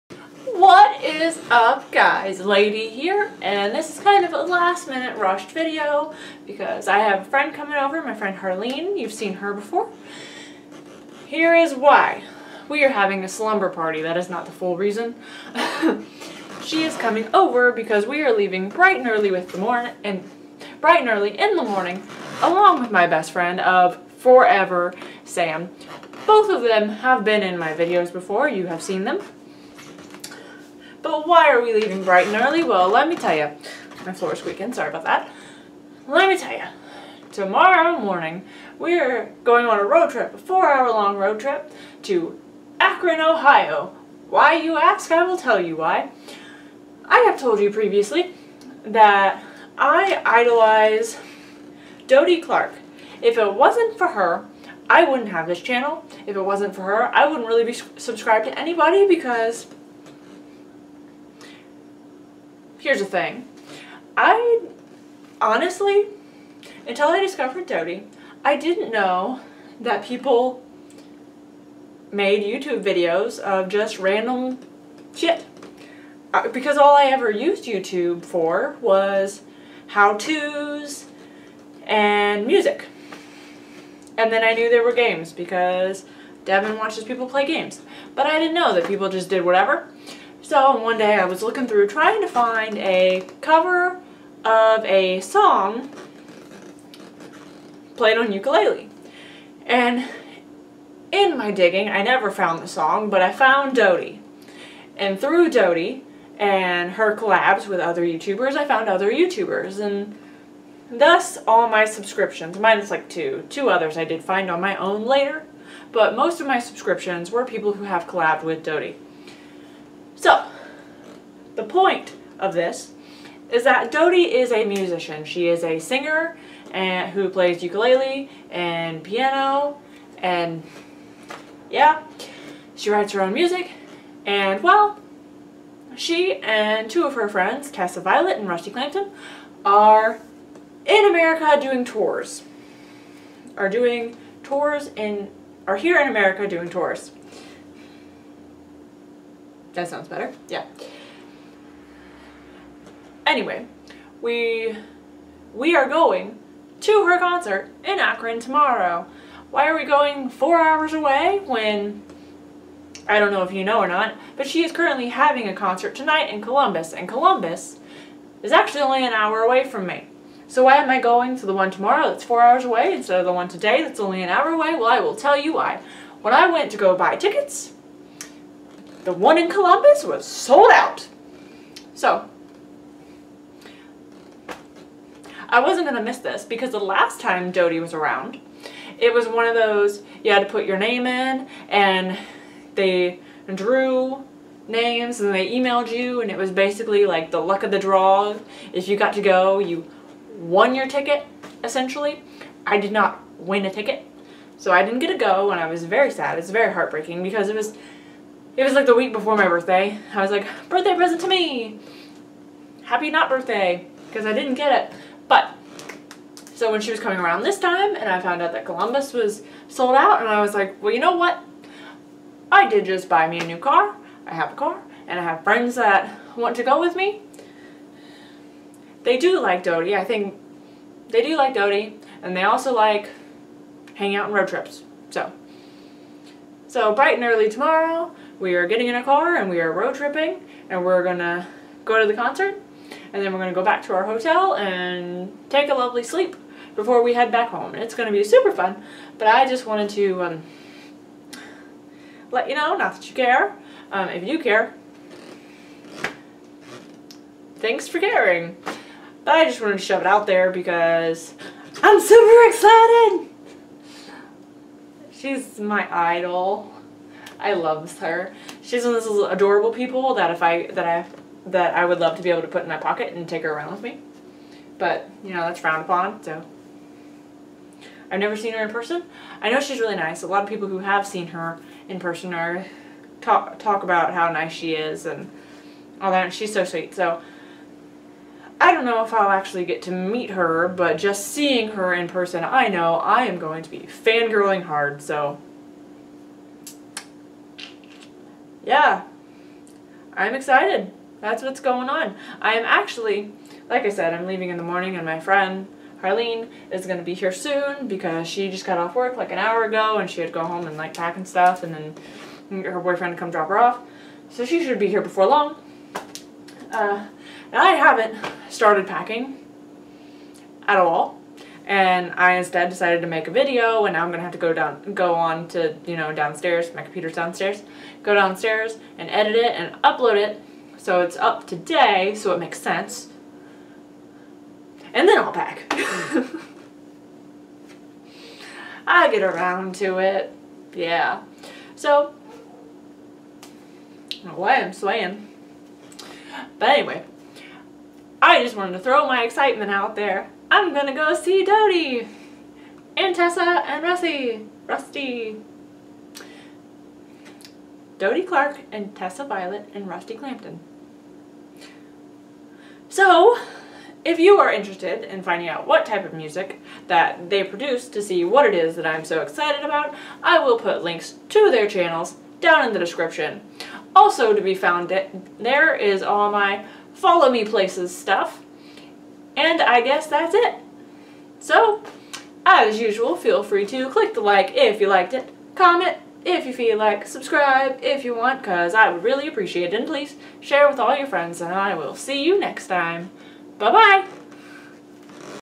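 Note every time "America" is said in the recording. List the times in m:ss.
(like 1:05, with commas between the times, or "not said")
2:21, 2:26.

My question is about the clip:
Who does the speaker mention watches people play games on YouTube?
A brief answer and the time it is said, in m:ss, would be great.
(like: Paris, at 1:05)
Devin, at 1:26.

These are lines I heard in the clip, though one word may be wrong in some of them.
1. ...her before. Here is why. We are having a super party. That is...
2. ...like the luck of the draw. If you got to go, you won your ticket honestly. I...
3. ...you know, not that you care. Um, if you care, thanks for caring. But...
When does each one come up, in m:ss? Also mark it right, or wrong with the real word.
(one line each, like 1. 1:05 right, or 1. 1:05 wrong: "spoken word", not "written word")
1. 0:09 wrong: "slumber", not "super"
2. 3:17 wrong: "essentially", not "honestly"
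3. 4:12 right.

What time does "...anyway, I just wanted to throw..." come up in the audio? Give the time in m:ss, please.
5:46.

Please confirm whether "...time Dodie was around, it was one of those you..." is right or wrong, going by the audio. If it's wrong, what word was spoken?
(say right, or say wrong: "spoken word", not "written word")
right.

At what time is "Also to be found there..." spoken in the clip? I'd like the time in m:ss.
6:13.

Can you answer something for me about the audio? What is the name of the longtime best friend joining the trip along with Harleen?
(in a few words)
Sam.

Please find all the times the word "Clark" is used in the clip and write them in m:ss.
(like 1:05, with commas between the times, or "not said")
0:52, 5:58.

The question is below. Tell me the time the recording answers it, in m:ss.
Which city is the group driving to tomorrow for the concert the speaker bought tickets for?
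0:42.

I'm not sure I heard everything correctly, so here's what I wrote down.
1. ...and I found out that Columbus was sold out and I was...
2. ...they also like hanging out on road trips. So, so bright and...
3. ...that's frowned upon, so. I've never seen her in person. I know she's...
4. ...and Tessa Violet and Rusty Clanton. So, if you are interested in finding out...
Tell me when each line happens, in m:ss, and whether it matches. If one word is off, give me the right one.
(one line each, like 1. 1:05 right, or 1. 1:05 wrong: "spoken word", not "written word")
1. 3:37 right
2. 3:52 right
3. 4:35 right
4. 5:58 right.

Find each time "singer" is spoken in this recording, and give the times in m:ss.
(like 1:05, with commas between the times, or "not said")
2:05.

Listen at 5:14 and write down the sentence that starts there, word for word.
So she should be here before long.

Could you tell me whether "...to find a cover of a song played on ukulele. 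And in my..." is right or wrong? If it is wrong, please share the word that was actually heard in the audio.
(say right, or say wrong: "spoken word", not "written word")
right.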